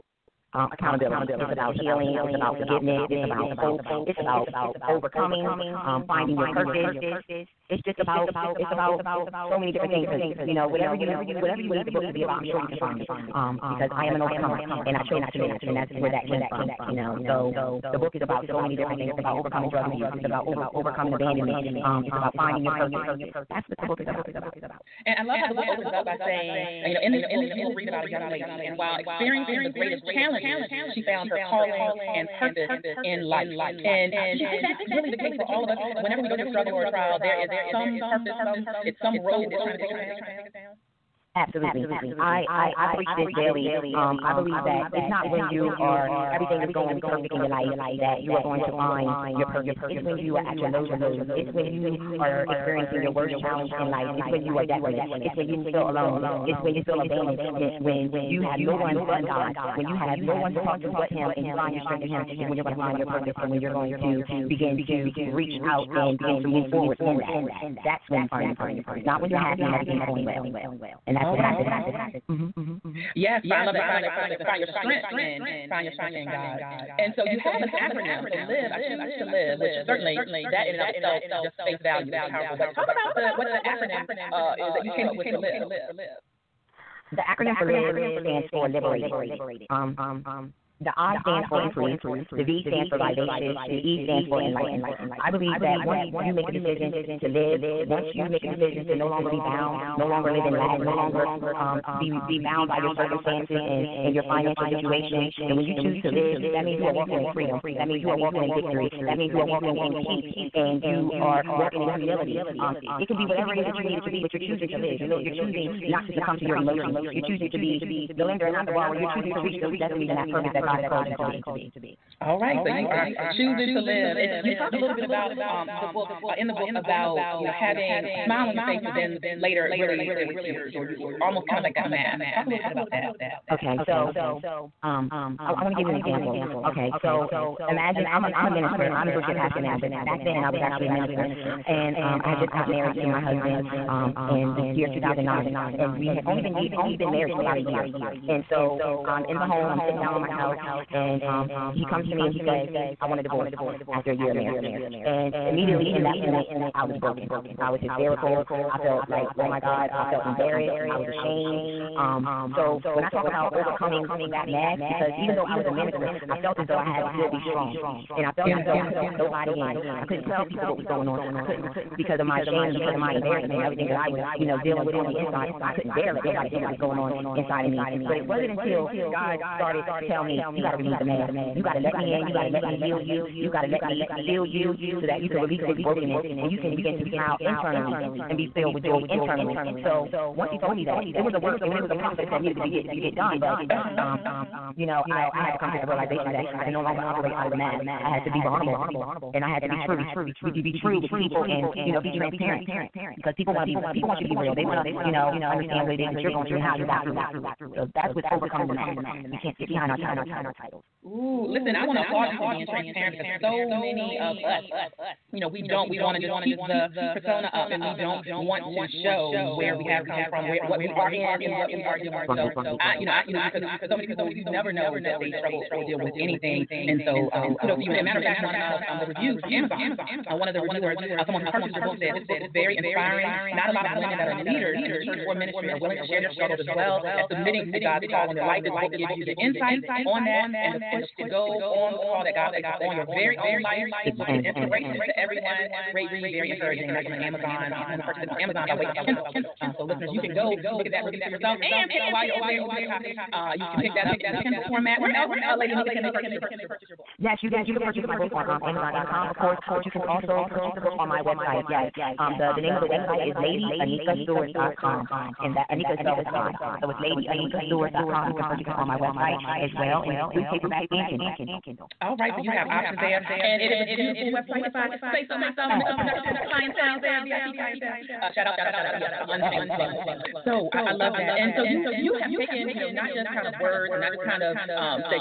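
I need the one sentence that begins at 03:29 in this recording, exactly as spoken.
We can't sit behind our titles.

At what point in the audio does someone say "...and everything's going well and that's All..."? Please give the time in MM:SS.
01:09.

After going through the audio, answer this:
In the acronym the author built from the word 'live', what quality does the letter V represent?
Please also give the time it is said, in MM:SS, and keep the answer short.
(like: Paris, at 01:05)
Vivacious, at 01:32.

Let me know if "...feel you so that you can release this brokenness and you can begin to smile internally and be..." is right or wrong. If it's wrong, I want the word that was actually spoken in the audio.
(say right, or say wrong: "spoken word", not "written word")
right.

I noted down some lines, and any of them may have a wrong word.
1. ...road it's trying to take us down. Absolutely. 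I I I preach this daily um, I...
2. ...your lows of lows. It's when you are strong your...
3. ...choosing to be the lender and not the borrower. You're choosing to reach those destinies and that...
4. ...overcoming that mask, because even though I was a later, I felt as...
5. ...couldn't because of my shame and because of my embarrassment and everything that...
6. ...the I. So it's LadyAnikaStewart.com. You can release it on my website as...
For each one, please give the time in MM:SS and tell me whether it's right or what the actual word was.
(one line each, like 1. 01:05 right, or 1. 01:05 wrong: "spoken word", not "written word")
1. 00:39 right
2. 00:50 wrong: "experiencing", not "strong"
3. 01:57 right
4. 02:43 wrong: "minister", not "later"
5. 02:51 right
6. 04:26 wrong: "purchase", not "release".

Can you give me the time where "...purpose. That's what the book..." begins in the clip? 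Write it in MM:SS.
00:22.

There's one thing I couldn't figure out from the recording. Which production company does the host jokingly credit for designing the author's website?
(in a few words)
Mitchell Productions.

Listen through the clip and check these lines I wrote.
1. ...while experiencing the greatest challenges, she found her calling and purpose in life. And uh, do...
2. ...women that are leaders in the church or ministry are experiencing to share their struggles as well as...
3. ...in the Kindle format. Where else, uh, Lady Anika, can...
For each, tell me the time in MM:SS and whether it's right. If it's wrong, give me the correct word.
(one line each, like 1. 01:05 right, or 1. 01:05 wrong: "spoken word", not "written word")
1. 00:28 right
2. 03:53 wrong: "willing", not "experiencing"
3. 04:14 right.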